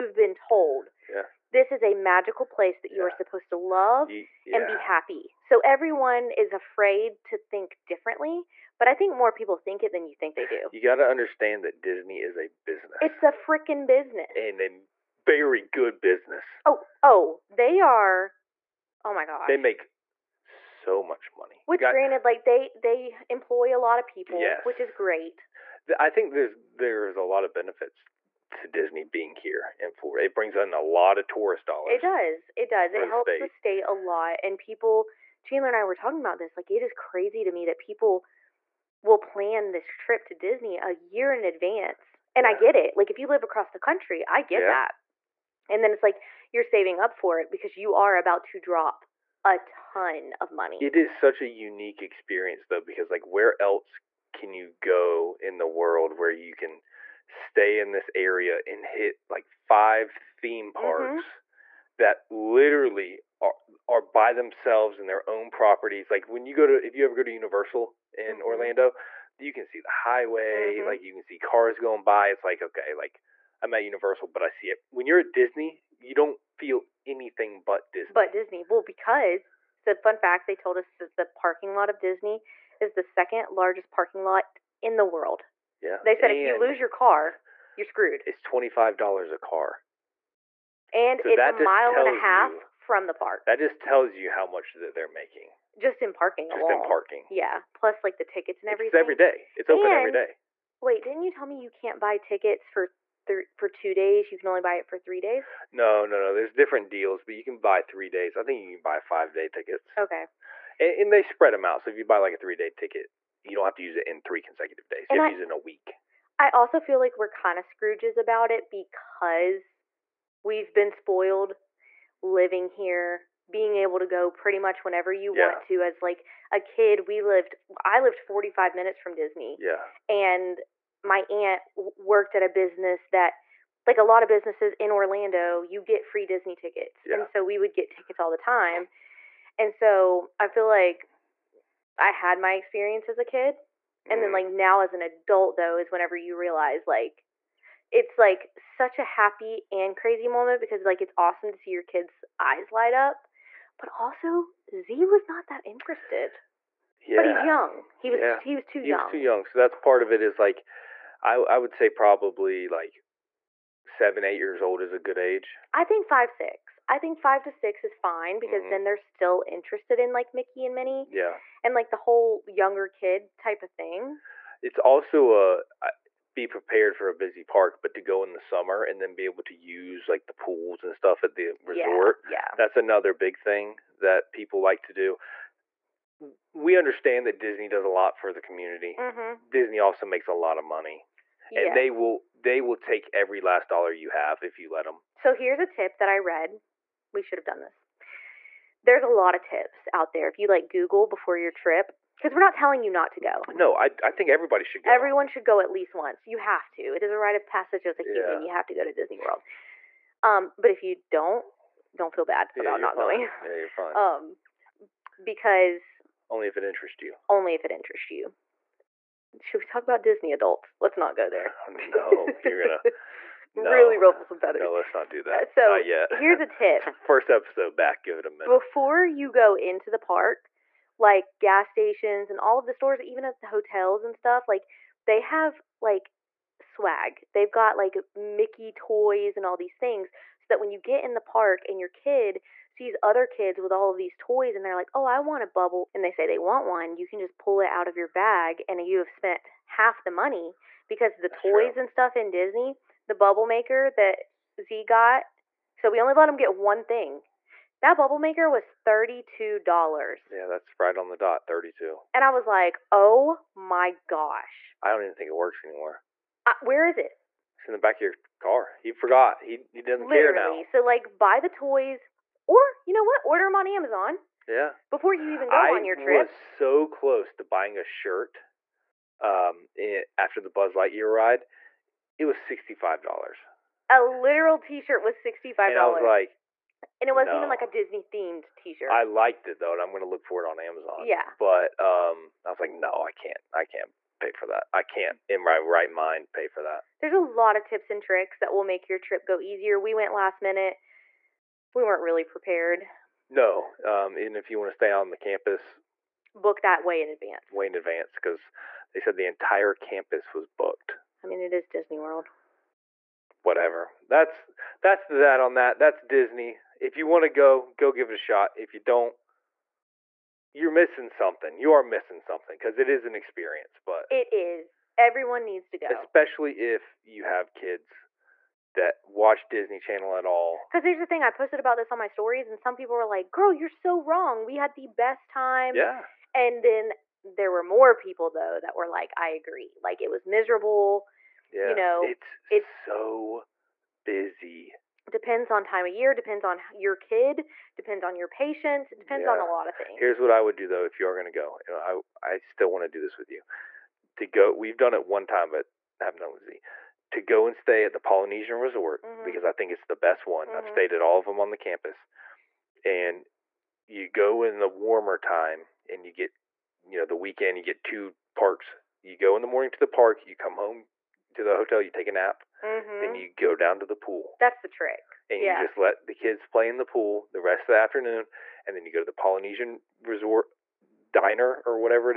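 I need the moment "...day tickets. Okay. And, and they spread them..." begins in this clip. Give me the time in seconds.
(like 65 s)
109 s.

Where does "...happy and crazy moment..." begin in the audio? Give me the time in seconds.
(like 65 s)
149 s.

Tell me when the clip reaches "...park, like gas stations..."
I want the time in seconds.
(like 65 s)
229 s.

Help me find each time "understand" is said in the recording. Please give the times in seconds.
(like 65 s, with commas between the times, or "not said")
11 s, 186 s.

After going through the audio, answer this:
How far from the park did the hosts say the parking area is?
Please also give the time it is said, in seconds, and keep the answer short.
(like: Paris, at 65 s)
A mile and a half, at 91 s.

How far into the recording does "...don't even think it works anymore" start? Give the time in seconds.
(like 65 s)
264 s.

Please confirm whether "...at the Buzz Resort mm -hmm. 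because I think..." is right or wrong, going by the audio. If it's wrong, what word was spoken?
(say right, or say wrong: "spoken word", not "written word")
wrong: "Polynesian", not "Buzz".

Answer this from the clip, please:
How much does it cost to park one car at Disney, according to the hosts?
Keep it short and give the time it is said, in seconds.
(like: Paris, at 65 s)
$25, at 88 s.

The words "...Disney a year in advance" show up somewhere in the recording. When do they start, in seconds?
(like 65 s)
40 s.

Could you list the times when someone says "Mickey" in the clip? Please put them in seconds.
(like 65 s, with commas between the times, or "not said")
170 s, 238 s.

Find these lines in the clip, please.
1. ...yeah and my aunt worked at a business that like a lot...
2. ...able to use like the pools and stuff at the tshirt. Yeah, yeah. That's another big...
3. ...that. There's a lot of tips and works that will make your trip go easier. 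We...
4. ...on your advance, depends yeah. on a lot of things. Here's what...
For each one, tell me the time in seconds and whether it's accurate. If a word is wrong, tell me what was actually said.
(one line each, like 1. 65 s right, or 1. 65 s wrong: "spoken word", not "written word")
1. 129 s right
2. 179 s wrong: "resort", not "tshirt"
3. 296 s wrong: "tricks", not "works"
4. 348 s wrong: "patience", not "advance".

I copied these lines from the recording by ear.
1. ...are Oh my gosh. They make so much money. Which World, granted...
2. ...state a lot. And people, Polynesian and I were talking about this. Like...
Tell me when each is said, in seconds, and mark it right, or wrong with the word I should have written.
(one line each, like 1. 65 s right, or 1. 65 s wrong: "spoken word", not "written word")
1. 17 s wrong: "Got", not "World"
2. 33 s wrong: "Chandler", not "Polynesian".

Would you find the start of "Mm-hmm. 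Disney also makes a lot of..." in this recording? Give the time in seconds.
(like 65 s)
188 s.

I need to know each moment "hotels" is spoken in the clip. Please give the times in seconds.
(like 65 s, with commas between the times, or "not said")
233 s, 371 s.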